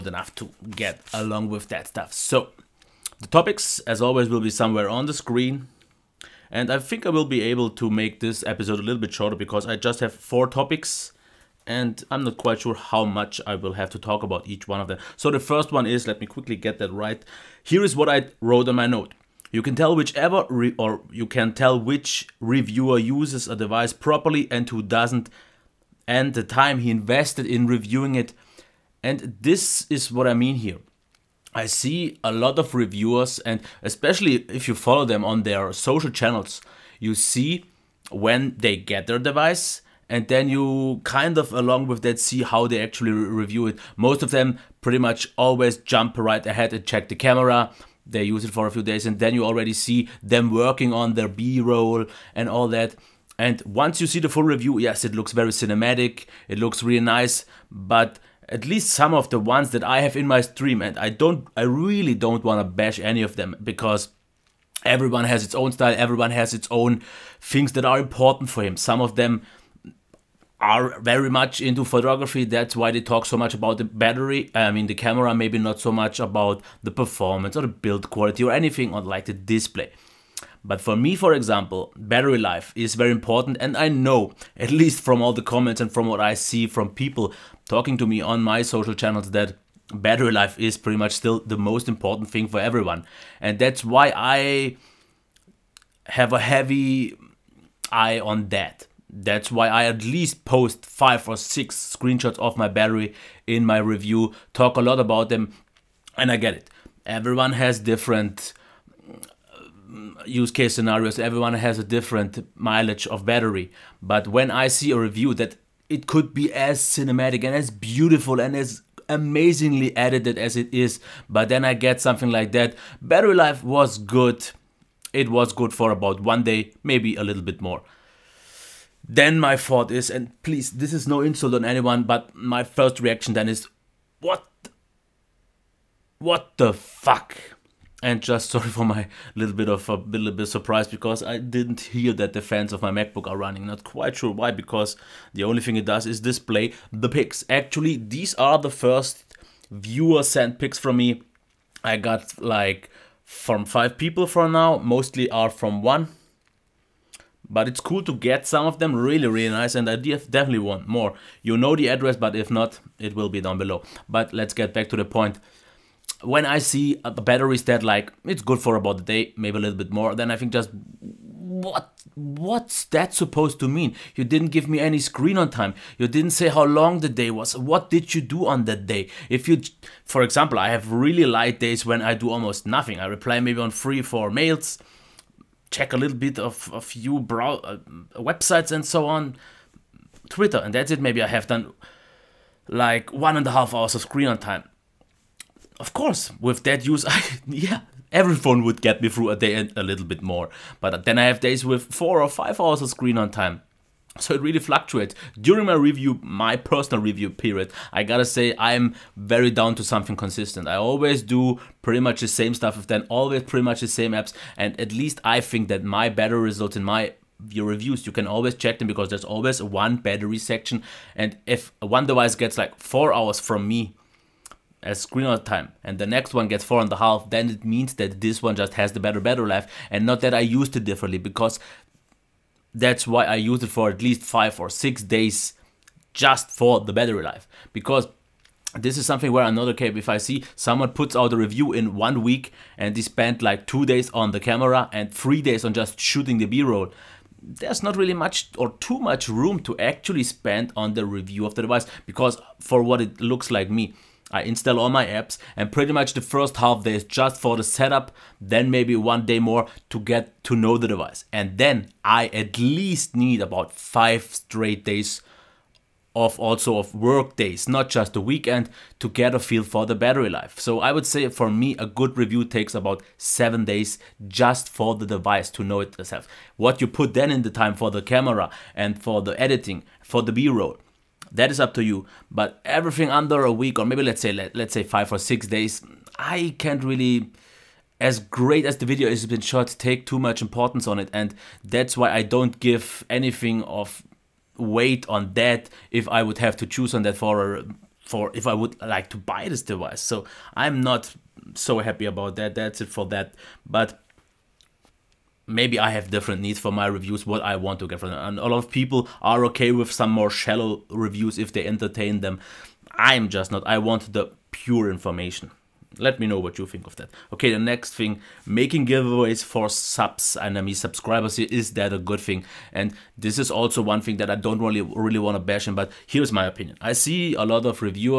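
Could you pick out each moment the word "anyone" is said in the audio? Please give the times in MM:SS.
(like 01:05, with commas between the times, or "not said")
02:11.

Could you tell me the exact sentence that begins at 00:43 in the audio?
Most of them pretty much always jump right ahead and check the camera.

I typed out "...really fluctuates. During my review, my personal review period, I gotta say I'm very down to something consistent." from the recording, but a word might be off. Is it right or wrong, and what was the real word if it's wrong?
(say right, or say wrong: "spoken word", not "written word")
right.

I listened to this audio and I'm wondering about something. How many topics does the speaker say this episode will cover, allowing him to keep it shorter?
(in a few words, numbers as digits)
4.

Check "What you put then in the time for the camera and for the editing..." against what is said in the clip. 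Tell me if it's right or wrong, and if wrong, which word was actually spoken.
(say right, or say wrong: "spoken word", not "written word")
right.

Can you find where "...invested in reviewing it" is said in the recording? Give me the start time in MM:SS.
00:26.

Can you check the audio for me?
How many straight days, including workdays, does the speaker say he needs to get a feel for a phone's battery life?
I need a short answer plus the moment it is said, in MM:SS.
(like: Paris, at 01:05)
5, at 04:23.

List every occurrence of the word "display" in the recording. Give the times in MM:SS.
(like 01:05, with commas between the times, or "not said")
01:19, 02:26.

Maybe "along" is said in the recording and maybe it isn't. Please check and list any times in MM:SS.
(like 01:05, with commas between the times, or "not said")
00:01, 00:41.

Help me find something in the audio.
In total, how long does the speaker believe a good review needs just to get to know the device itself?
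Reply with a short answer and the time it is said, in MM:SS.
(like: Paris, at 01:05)
7 days, at 04:33.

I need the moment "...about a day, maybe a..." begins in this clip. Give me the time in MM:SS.
02:48.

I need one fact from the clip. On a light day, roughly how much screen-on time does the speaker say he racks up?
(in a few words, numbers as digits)
1.5 hours.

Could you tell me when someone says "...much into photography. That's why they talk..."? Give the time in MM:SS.
01:11.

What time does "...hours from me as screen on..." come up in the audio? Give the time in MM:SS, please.
03:43.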